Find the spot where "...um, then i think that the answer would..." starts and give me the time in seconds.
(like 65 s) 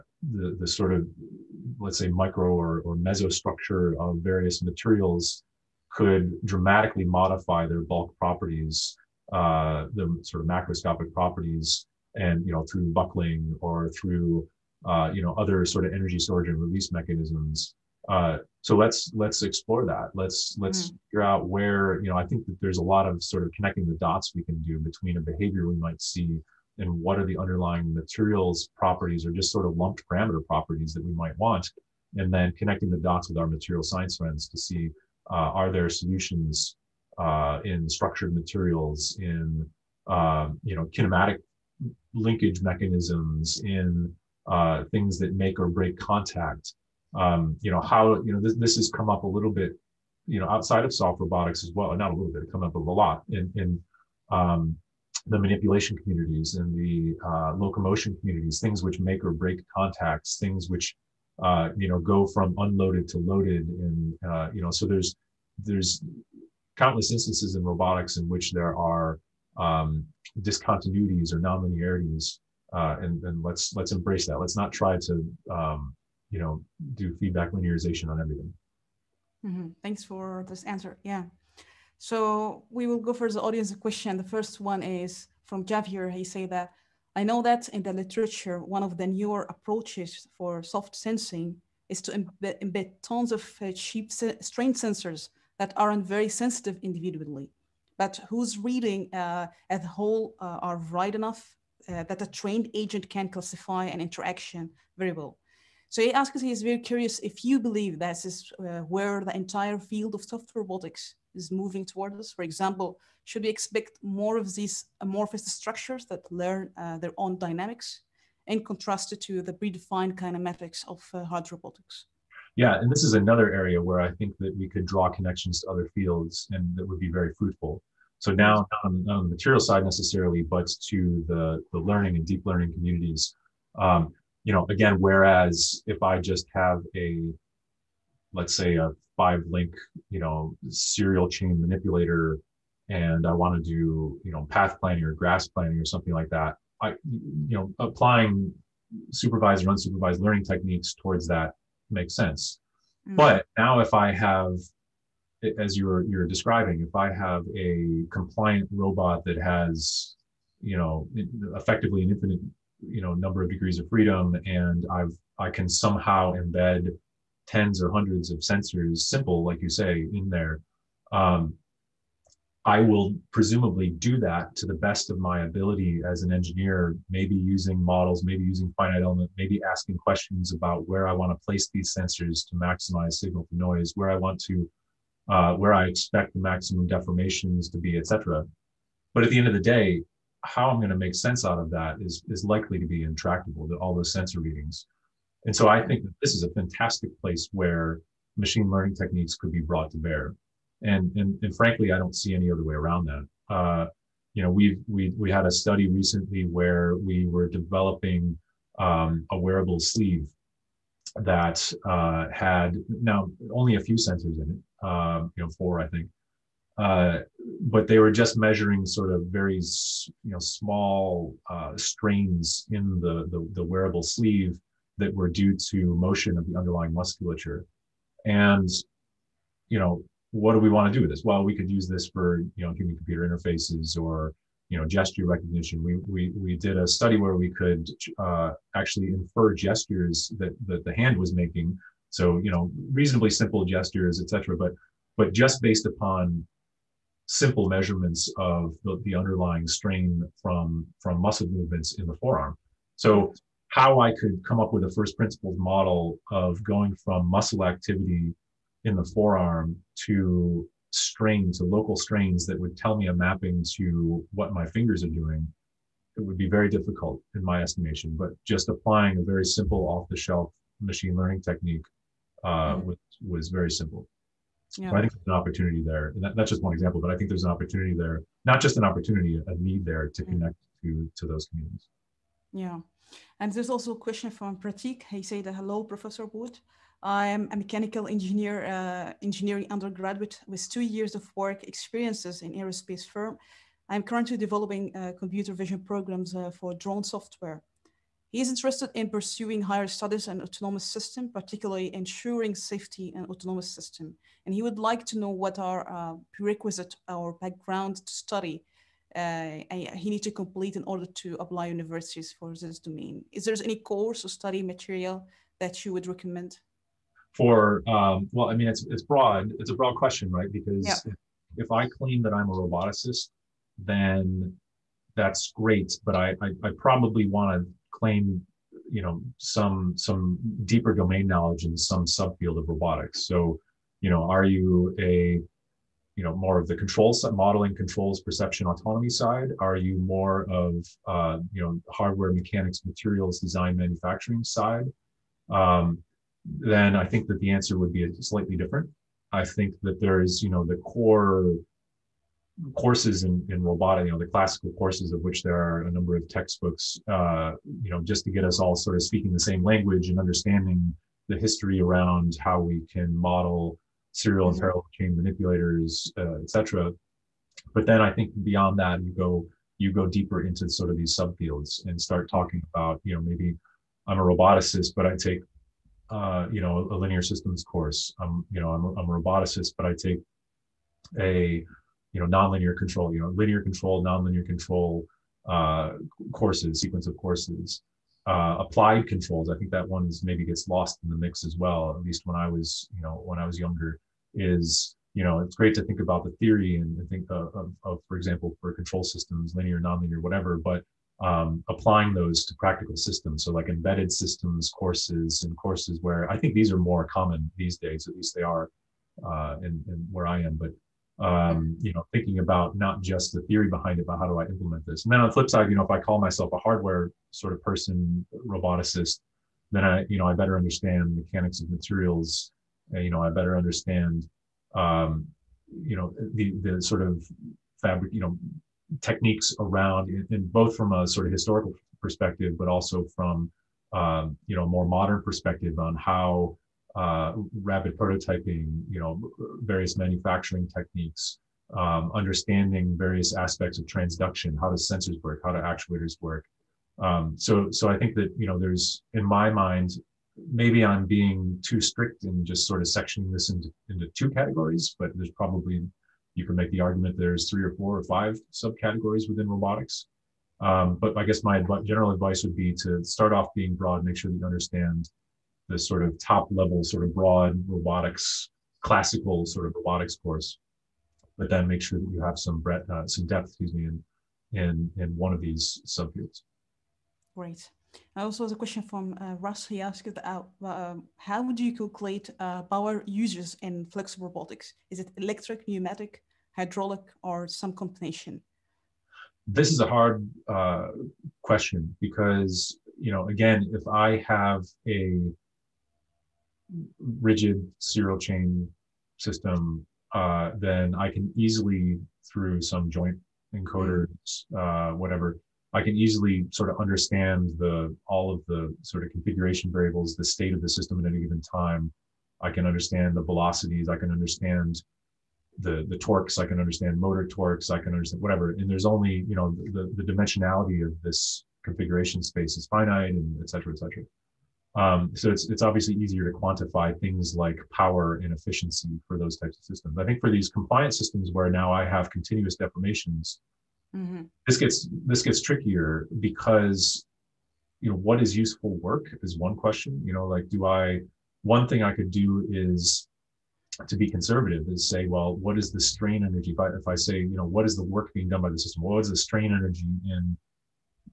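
345 s.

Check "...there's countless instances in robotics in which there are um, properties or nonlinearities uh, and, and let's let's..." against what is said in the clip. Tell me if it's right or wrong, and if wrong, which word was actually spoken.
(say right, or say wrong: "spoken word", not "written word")
wrong: "discontinuities", not "properties".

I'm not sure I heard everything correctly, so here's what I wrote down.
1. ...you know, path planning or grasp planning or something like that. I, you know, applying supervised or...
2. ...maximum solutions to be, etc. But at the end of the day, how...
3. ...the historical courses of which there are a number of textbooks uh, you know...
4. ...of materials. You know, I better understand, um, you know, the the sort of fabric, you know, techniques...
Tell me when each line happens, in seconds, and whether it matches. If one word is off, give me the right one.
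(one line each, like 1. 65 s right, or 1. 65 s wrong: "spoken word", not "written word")
1. 144 s right
2. 186 s wrong: "deformations", not "solutions"
3. 354 s wrong: "classical", not "historical"
4. 421 s right.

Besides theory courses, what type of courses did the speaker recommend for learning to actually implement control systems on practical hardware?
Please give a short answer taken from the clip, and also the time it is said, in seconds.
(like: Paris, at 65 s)
embedded systems courses, at 403 s.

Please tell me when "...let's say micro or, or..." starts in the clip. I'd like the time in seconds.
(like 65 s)
1 s.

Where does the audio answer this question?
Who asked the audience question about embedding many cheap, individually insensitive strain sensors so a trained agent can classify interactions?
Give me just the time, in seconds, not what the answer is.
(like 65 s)
85 s.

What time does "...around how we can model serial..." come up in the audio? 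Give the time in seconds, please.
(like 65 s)
361 s.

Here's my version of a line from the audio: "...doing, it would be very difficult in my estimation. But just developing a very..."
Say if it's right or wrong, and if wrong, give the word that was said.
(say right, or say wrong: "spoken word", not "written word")
wrong: "applying", not "developing".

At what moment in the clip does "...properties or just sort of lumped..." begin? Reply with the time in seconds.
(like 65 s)
28 s.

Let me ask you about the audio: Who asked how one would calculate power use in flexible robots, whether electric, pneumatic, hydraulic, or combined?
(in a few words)
Russ.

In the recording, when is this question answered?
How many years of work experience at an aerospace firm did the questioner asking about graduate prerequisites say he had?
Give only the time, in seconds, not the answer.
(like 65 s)
290 s.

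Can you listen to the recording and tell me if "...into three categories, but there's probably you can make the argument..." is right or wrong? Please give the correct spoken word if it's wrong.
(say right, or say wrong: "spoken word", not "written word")
wrong: "two", not "three".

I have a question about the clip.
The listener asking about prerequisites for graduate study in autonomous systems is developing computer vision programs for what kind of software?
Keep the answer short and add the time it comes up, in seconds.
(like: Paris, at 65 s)
drone software, at 296 s.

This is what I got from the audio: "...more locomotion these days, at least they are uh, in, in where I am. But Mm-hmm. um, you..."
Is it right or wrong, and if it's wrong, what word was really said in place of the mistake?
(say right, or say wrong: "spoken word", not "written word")
wrong: "common", not "locomotion".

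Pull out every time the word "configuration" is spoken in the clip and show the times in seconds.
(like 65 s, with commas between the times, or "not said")
509 s, 521 s.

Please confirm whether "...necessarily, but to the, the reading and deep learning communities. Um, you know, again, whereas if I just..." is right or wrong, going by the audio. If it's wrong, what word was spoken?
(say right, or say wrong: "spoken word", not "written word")
wrong: "learning", not "reading".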